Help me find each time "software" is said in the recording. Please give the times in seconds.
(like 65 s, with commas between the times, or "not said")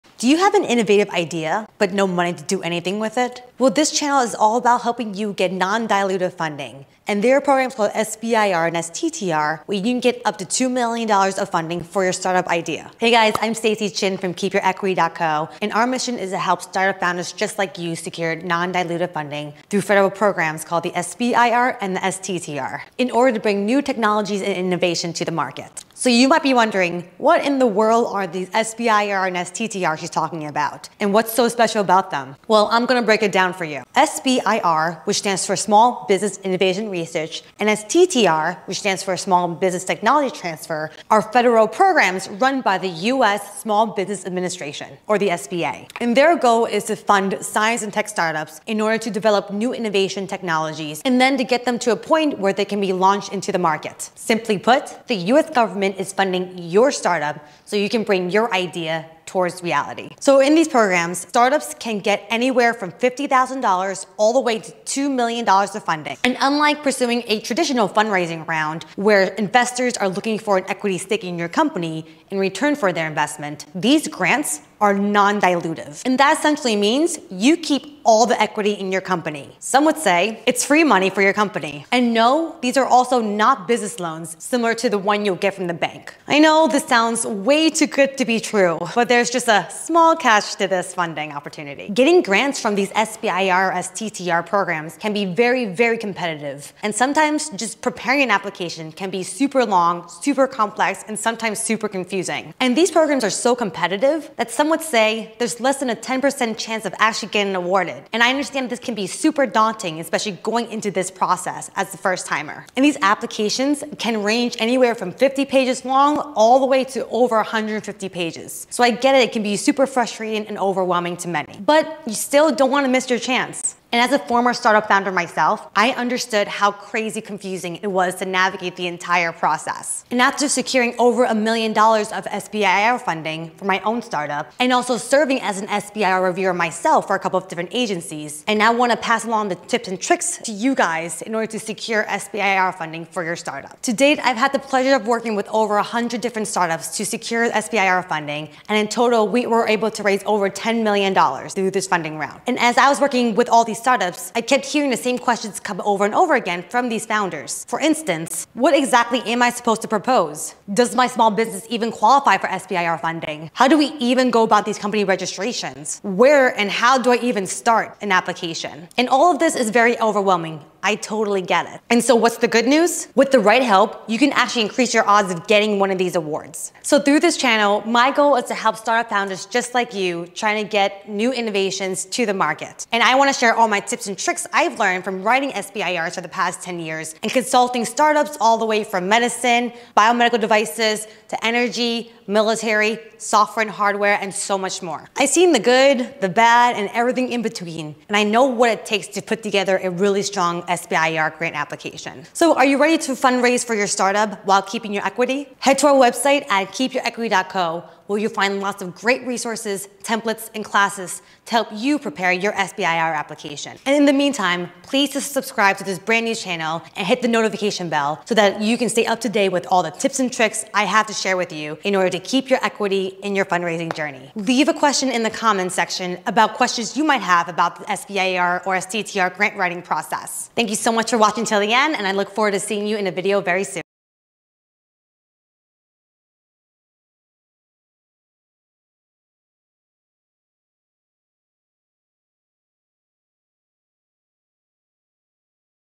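193 s.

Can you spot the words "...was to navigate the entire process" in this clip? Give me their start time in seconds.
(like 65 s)
127 s.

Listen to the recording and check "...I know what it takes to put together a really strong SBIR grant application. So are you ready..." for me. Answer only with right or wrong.
right.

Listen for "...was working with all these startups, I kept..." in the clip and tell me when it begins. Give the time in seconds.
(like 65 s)
152 s.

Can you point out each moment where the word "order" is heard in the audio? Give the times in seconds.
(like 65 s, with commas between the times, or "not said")
23 s, 48 s, 141 s, 221 s.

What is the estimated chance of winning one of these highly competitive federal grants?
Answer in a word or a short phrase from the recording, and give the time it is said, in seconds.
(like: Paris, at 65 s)
Less than 10%, at 105 s.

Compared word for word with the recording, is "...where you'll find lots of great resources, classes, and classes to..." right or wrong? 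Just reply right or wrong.
wrong.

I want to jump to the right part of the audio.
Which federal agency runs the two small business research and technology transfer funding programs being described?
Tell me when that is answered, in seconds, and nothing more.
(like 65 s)
43 s.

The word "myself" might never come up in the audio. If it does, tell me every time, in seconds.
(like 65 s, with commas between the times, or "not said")
125 s, 136 s.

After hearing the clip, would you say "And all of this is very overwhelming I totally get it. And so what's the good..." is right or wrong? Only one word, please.
right.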